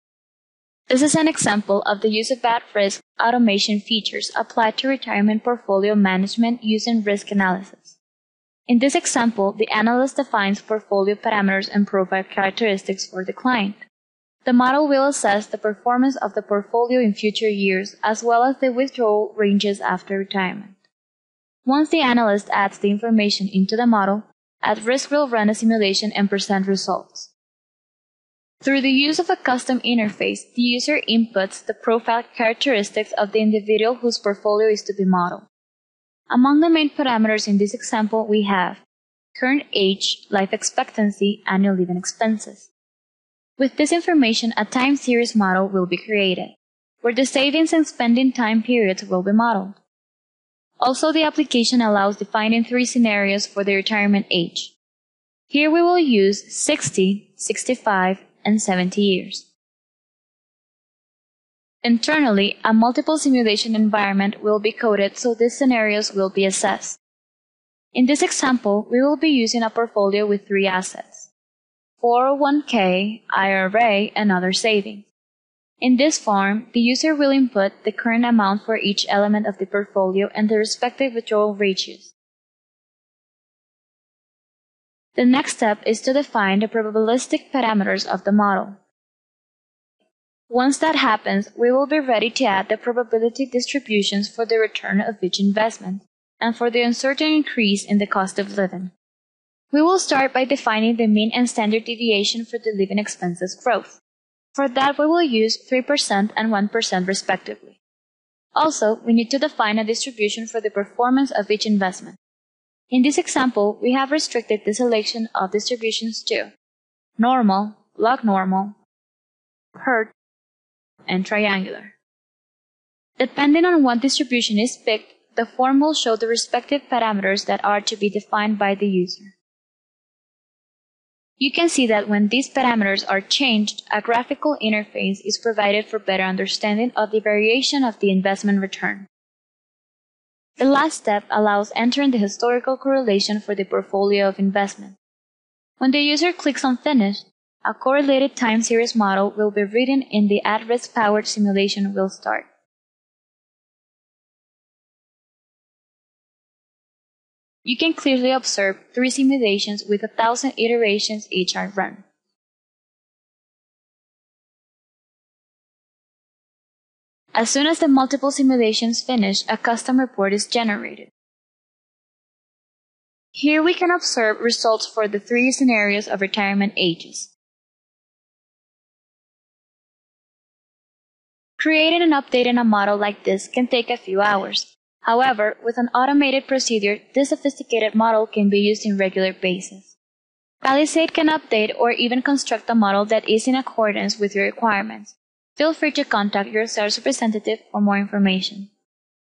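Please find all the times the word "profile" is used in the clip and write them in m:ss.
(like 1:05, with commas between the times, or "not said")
0:11, 0:31.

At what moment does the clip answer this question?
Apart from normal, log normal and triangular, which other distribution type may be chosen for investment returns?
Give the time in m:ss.
1:59.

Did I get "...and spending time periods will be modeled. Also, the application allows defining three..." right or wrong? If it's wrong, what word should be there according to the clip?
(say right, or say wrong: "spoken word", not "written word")
right.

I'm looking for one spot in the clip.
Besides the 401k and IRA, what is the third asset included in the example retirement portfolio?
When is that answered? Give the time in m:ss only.
1:14.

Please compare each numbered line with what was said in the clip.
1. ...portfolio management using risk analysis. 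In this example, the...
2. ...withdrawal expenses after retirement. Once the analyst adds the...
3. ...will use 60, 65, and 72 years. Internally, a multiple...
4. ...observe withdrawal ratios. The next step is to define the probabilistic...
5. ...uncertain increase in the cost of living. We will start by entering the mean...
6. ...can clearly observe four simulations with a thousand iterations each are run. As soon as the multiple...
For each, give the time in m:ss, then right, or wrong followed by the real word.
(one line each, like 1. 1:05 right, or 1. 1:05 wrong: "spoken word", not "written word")
1. 0:05 right
2. 0:18 wrong: "ranges", not "expenses"
3. 0:55 wrong: "70", not "72"
4. 1:20 wrong: "respective", not "observe"
5. 1:36 wrong: "defining", not "entering"
6. 2:37 wrong: "three", not "four".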